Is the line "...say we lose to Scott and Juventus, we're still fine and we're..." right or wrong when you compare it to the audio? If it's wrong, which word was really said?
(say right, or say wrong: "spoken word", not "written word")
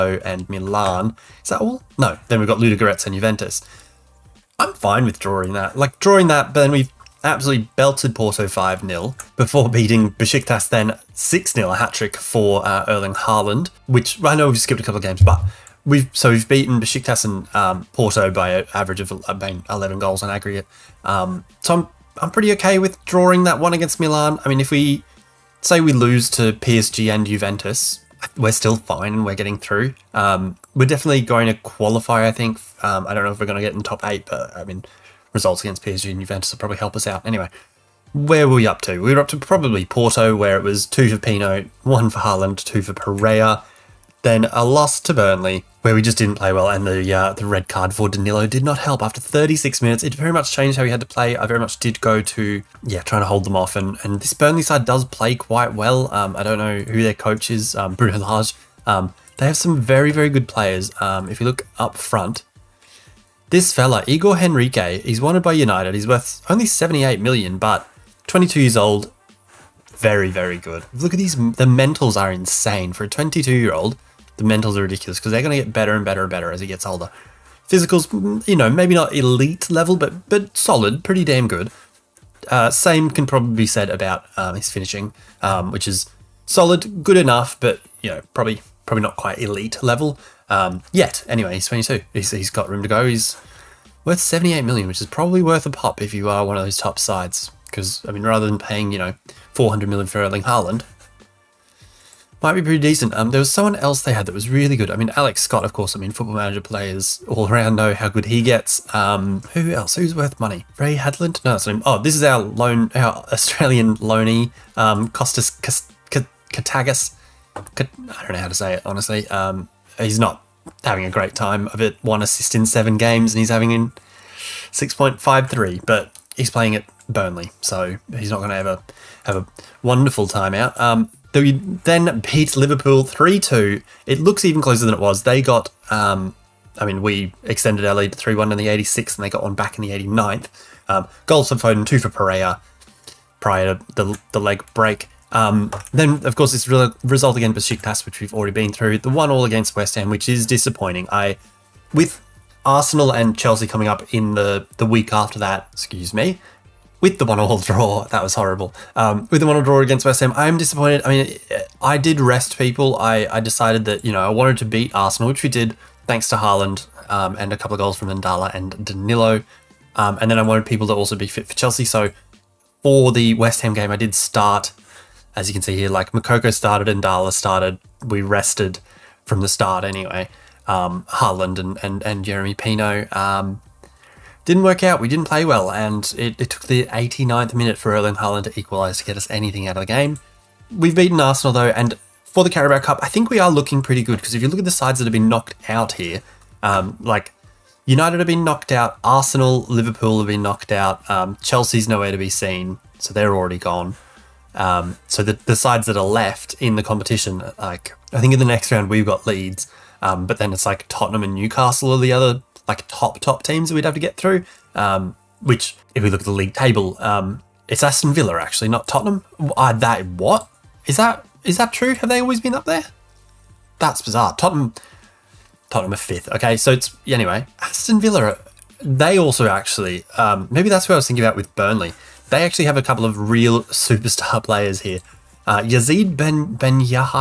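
wrong: "PSG", not "Scott".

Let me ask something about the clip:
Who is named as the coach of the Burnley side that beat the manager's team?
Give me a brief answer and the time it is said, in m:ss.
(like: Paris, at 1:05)
Bruno Lage, at 0:57.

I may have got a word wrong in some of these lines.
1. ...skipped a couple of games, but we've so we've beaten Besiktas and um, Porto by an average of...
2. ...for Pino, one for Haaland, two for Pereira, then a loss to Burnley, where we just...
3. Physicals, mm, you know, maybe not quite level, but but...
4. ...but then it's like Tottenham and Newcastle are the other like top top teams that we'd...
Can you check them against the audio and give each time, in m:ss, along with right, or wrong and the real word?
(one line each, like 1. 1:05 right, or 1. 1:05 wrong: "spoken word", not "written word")
1. 0:14 right
2. 0:41 right
3. 1:17 wrong: "elite", not "quite"
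4. 3:30 right.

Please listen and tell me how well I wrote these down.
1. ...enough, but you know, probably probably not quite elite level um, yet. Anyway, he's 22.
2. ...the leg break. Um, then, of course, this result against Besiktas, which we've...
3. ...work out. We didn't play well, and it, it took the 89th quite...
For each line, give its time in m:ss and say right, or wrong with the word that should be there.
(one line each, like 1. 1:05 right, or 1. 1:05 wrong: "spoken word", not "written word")
1. 1:27 right
2. 2:24 right
3. 3:04 wrong: "minute", not "quite".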